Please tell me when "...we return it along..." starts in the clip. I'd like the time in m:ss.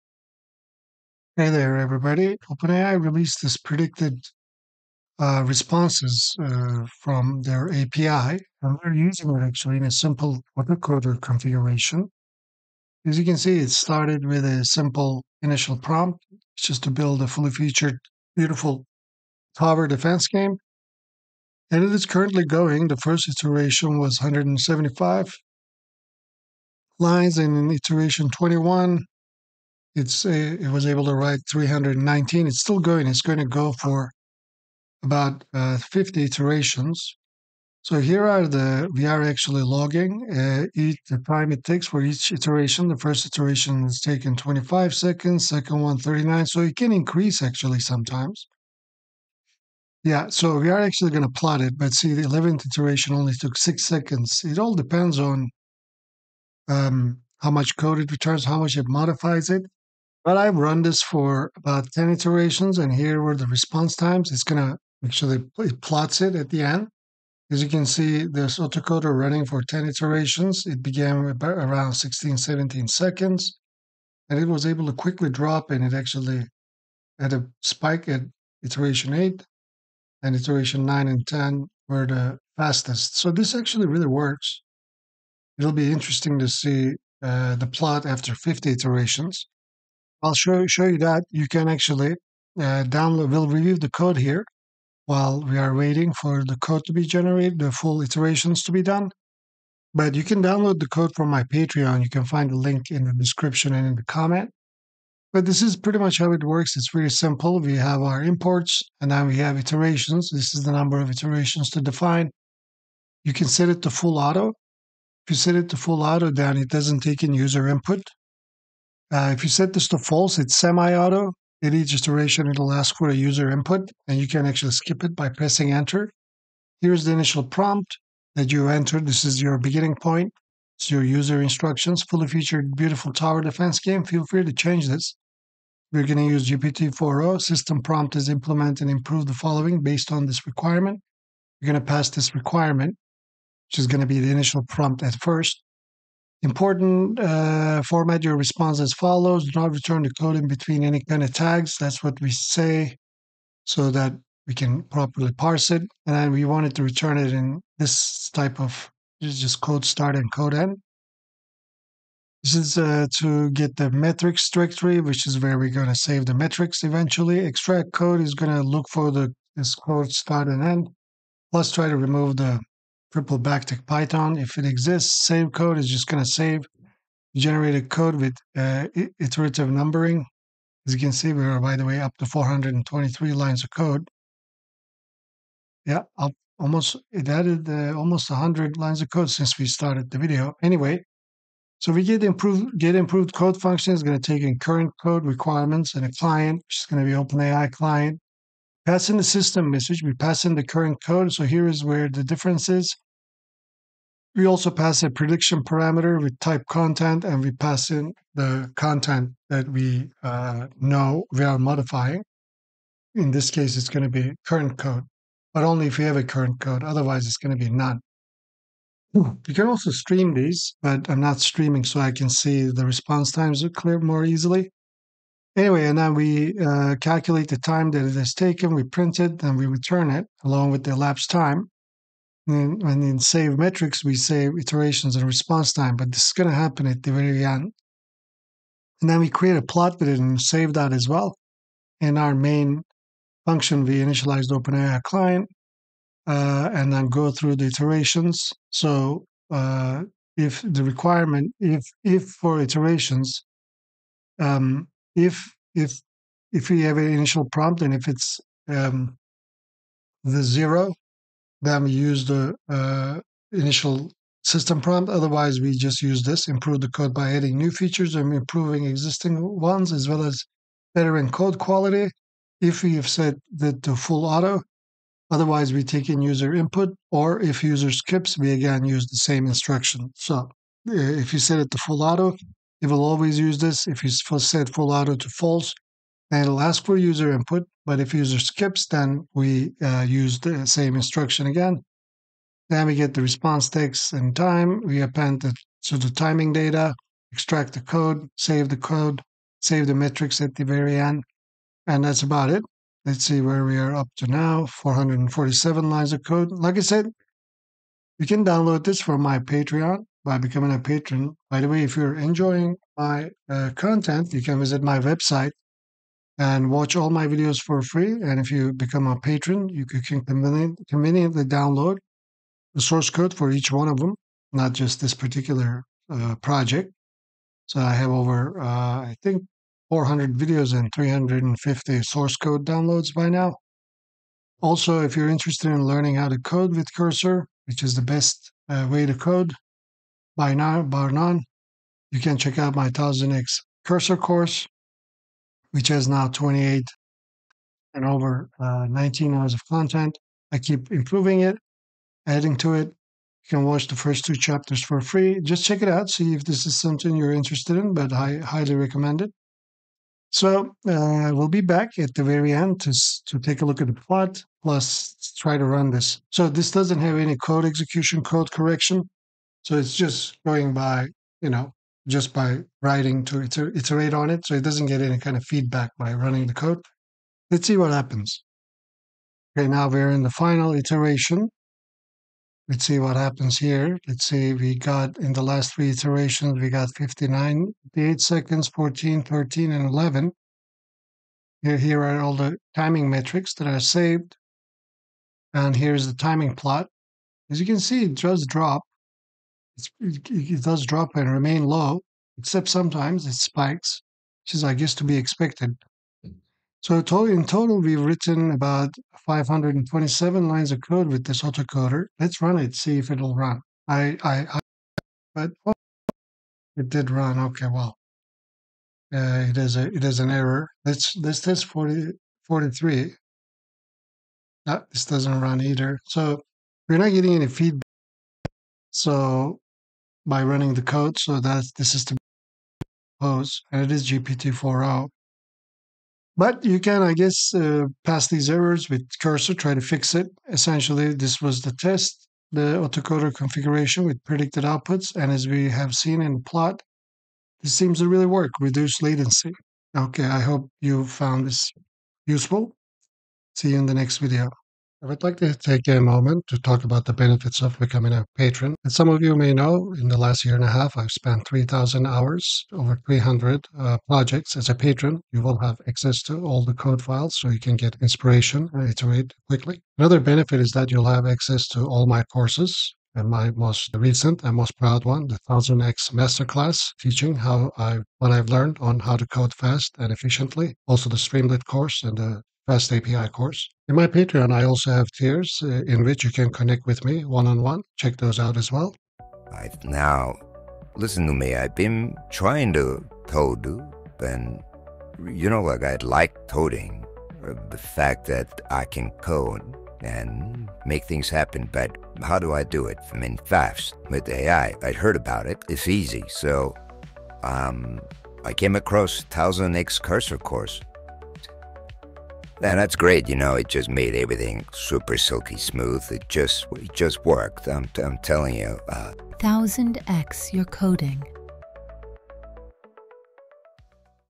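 3:49.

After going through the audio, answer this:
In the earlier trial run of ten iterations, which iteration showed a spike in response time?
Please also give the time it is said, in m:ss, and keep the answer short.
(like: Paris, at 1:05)
8, at 1:18.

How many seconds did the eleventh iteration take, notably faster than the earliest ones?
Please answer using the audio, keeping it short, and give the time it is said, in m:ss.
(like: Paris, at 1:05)
6 seconds, at 0:53.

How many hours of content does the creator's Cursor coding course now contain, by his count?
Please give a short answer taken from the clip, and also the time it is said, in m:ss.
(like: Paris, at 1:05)
19 hours, at 5:48.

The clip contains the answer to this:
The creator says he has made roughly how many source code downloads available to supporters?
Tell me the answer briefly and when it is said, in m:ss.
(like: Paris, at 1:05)
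350, at 5:30.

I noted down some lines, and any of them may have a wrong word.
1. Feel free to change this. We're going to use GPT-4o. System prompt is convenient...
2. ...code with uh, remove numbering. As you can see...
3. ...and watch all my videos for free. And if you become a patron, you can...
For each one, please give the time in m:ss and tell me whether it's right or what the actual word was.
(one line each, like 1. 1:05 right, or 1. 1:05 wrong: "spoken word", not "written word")
1. 2:14 wrong: "implement", not "convenient"
2. 2:57 wrong: "iterative", not "remove"
3. 5:16 right.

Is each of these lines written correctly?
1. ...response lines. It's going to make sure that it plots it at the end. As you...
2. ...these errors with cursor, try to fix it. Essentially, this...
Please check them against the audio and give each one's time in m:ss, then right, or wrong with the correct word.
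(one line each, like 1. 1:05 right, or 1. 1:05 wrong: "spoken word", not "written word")
1. 1:03 wrong: "times", not "lines"
2. 7:18 right.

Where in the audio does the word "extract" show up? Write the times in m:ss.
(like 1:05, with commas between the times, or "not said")
2:47, 4:57.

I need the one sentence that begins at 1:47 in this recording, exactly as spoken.
We have our imports and then we have iterations.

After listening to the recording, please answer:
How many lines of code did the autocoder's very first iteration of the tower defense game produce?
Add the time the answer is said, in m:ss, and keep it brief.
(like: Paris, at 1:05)
175, at 0:24.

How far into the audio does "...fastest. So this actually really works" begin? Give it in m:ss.
1:22.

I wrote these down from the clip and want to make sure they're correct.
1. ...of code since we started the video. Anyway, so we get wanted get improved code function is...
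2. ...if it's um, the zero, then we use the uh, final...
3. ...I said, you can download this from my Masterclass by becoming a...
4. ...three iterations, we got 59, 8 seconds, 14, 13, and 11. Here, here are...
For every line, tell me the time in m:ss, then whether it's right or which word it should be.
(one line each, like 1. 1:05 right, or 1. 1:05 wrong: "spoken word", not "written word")
1. 3:09 wrong: "improved", not "wanted"
2. 4:17 wrong: "initial", not "final"
3. 5:06 wrong: "Patreon", not "Masterclass"
4. 6:25 right.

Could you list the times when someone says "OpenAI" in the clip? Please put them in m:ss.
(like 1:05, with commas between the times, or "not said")
0:02, 3:17, 4:04.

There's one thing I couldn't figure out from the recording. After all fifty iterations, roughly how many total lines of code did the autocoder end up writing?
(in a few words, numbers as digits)
527.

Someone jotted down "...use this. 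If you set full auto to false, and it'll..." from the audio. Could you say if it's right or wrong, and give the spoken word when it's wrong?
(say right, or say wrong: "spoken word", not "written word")
right.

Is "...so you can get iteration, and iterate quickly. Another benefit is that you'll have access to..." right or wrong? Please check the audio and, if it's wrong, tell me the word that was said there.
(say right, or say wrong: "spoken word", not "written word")
wrong: "inspiration", not "iteration".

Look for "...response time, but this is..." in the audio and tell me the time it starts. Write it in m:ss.
3:55.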